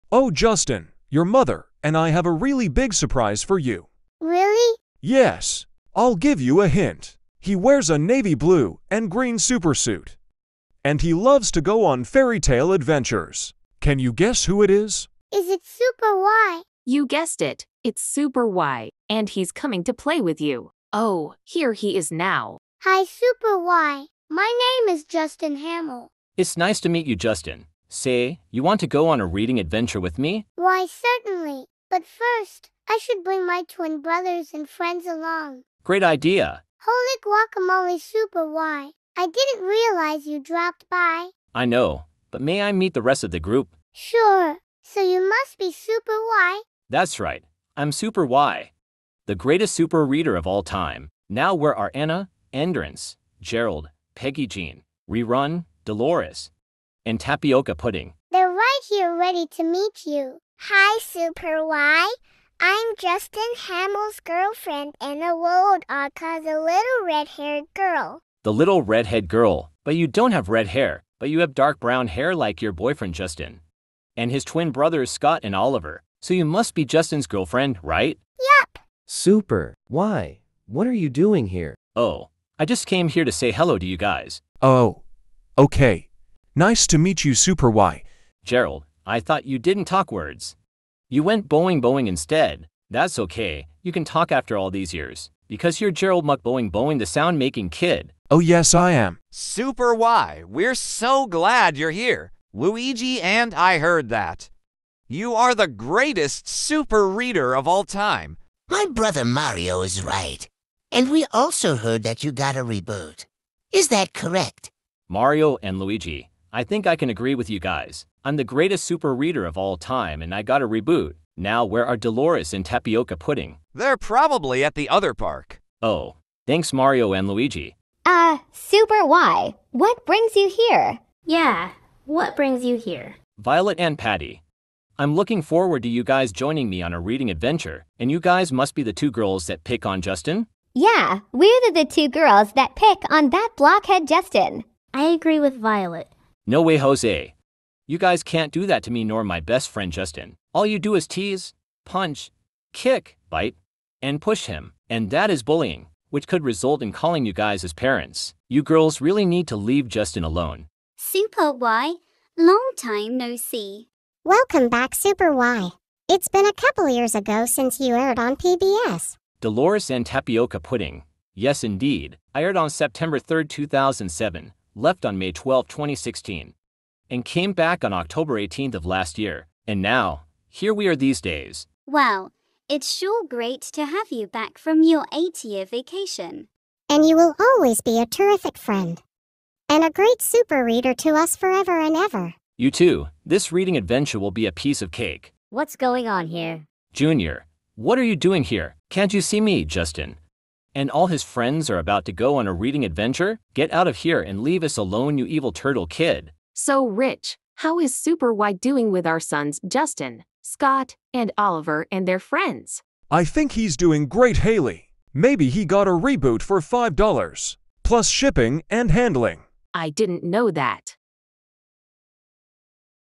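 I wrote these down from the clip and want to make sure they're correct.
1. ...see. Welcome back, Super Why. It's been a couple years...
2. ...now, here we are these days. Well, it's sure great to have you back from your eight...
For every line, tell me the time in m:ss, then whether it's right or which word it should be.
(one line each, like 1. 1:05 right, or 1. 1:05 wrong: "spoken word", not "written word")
1. 2:43 right
2. 2:59 right.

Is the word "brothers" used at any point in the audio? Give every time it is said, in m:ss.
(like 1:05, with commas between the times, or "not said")
0:34, 1:14, 1:48.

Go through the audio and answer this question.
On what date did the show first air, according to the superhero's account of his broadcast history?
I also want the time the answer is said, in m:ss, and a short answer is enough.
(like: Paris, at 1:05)
September 3, 2007, at 2:52.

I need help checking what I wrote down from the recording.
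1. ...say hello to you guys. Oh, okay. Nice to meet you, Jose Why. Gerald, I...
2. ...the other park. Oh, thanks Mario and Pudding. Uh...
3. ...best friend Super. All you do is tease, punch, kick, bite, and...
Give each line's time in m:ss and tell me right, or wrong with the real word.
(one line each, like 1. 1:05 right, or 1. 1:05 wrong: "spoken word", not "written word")
1. 1:23 wrong: "Super", not "Jose"
2. 2:04 wrong: "Luigi", not "Pudding"
3. 2:29 wrong: "Justin", not "Super".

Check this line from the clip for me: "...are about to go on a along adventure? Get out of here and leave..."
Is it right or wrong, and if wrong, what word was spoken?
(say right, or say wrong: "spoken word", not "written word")
wrong: "reading", not "along".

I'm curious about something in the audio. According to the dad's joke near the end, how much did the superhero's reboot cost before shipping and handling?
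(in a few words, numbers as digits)
$5.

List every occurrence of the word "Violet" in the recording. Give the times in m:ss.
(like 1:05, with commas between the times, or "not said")
2:13, 2:25.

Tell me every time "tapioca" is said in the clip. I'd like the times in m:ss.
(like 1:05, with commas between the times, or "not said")
0:57, 2:02, 2:50.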